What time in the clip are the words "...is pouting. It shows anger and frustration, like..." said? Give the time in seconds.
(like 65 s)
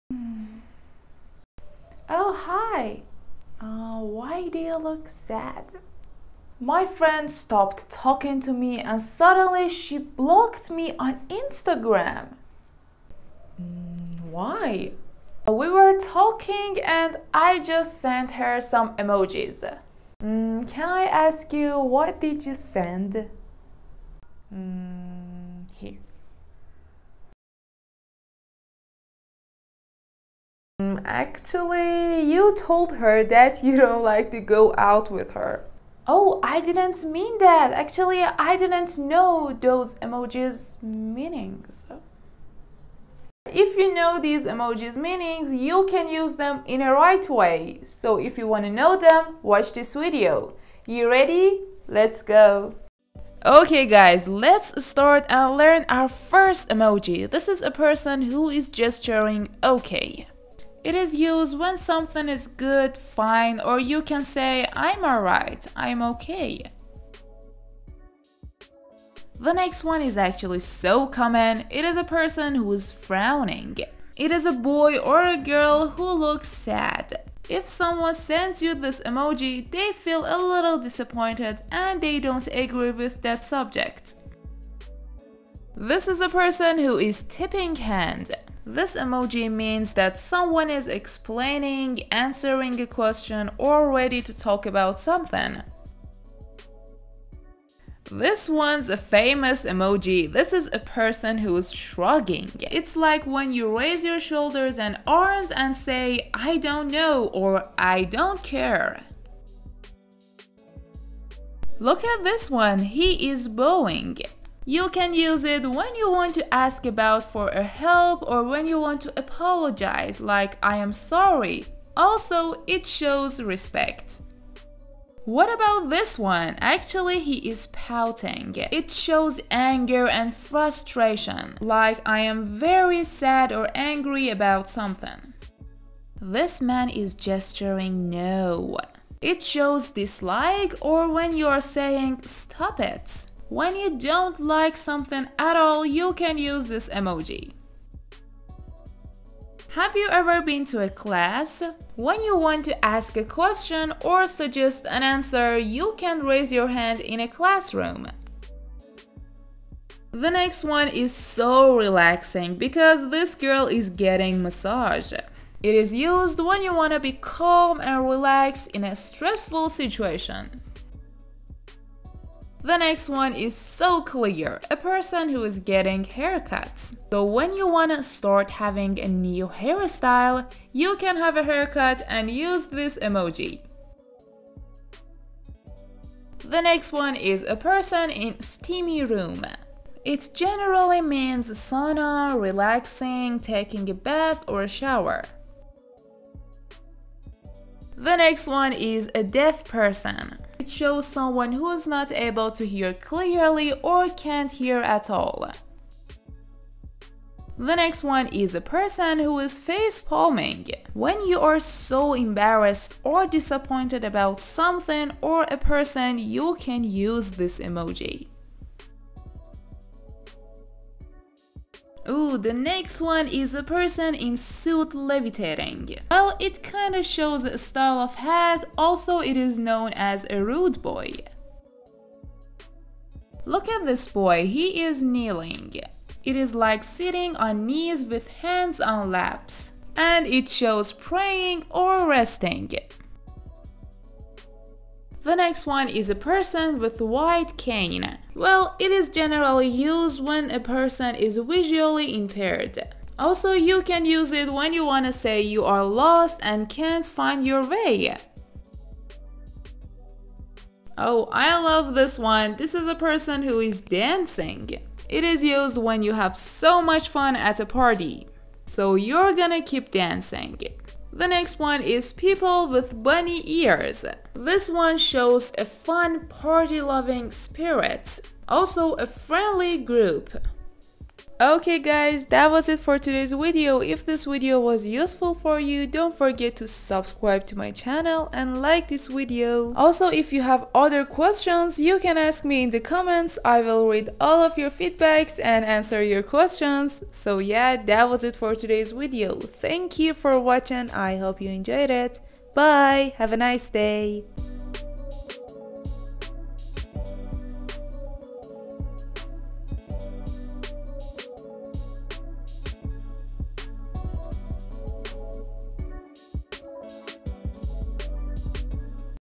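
127 s.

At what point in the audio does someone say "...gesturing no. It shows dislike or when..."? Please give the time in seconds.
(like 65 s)
137 s.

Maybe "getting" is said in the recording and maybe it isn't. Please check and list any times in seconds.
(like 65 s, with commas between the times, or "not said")
163 s, 175 s.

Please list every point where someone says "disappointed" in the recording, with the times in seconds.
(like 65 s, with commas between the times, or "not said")
80 s, 213 s.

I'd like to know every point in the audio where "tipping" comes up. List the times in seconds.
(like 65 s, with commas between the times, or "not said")
87 s.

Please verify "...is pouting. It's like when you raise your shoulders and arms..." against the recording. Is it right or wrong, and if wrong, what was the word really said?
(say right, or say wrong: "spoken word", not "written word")
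wrong: "shrugging", not "pouting".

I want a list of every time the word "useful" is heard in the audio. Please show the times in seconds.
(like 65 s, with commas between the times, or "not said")
284 s.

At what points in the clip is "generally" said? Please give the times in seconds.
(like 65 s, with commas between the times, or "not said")
190 s, 249 s.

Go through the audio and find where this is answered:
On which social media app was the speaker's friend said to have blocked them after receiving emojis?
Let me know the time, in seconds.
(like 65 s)
11 s.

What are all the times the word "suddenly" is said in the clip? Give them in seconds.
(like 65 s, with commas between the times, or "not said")
9 s.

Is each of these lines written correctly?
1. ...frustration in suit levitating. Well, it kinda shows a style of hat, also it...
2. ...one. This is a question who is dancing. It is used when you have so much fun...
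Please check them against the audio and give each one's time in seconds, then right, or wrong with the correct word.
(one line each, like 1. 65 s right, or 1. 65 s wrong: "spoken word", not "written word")
1. 223 s wrong: "person", not "frustration"
2. 262 s wrong: "person", not "question".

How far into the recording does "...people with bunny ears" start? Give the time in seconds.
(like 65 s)
272 s.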